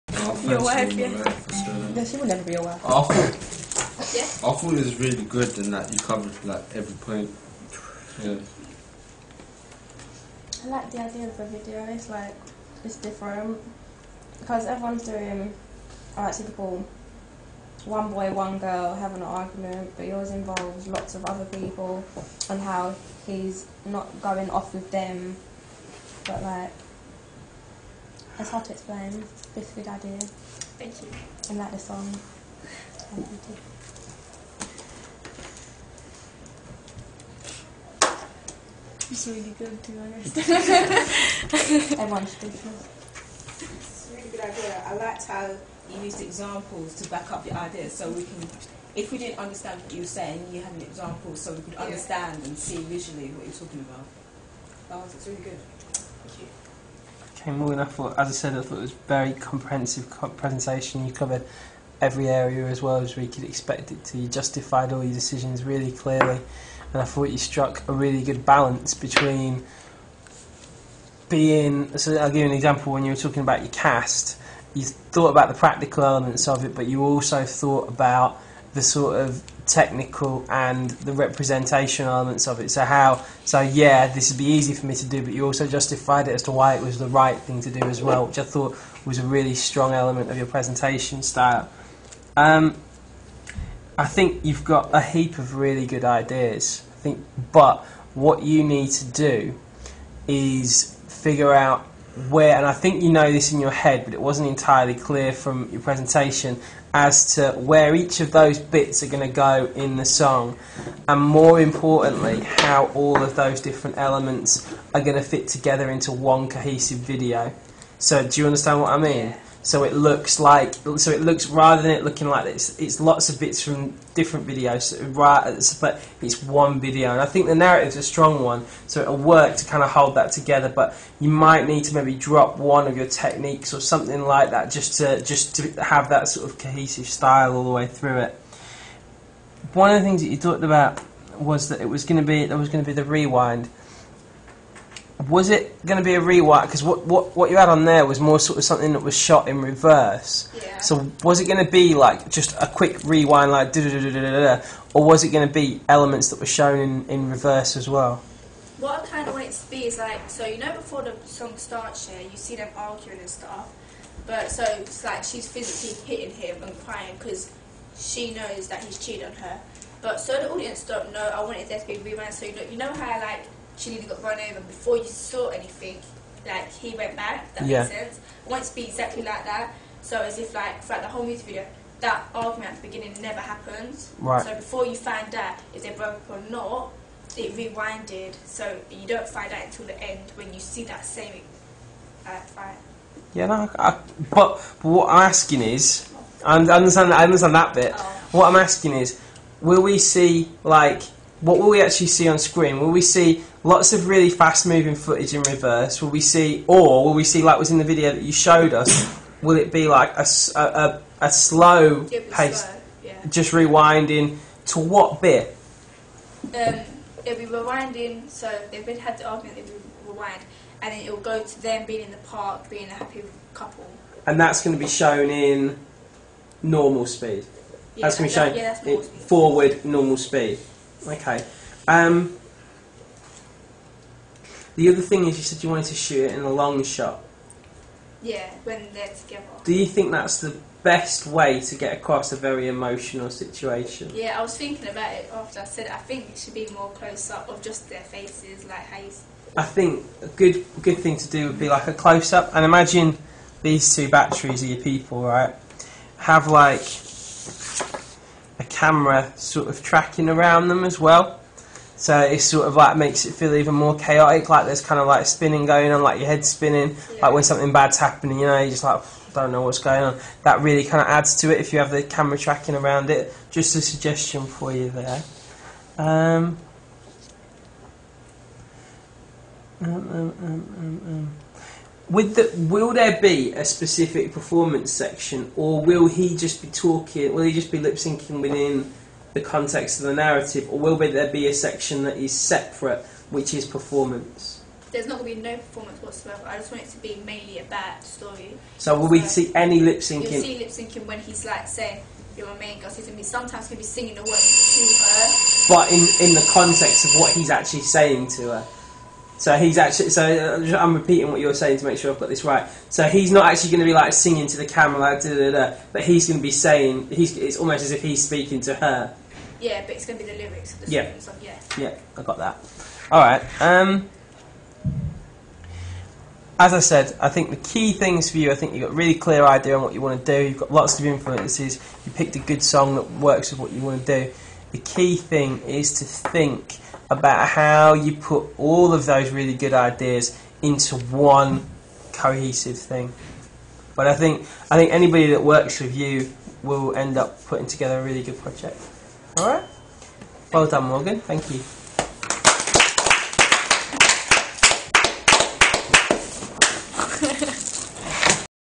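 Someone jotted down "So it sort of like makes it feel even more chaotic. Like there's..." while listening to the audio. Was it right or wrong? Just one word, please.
right.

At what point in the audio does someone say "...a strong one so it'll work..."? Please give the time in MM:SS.
02:07.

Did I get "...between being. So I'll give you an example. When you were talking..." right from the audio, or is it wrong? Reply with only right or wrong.
right.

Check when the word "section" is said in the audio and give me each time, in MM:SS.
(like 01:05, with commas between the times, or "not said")
04:44, 04:51.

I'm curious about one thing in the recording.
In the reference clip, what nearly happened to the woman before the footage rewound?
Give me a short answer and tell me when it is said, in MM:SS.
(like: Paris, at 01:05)
run over, at 02:54.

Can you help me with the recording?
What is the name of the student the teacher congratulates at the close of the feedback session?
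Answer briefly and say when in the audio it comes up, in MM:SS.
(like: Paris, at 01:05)
Morgan, at 05:50.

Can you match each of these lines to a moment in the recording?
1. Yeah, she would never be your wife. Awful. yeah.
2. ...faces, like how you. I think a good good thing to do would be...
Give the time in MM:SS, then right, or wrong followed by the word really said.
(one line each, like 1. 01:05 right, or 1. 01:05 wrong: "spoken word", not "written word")
1. 00:01 right
2. 04:08 right.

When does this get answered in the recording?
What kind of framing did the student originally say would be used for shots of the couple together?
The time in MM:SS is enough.
03:56.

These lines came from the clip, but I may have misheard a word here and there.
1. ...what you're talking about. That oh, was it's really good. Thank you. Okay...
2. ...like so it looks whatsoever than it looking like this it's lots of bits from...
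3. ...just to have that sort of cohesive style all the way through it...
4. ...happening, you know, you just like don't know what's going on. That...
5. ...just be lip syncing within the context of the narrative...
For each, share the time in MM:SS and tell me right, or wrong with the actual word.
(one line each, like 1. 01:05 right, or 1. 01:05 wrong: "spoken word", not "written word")
1. 00:53 right
2. 02:00 wrong: "rather", not "whatsoever"
3. 02:15 right
4. 04:27 right
5. 04:47 right.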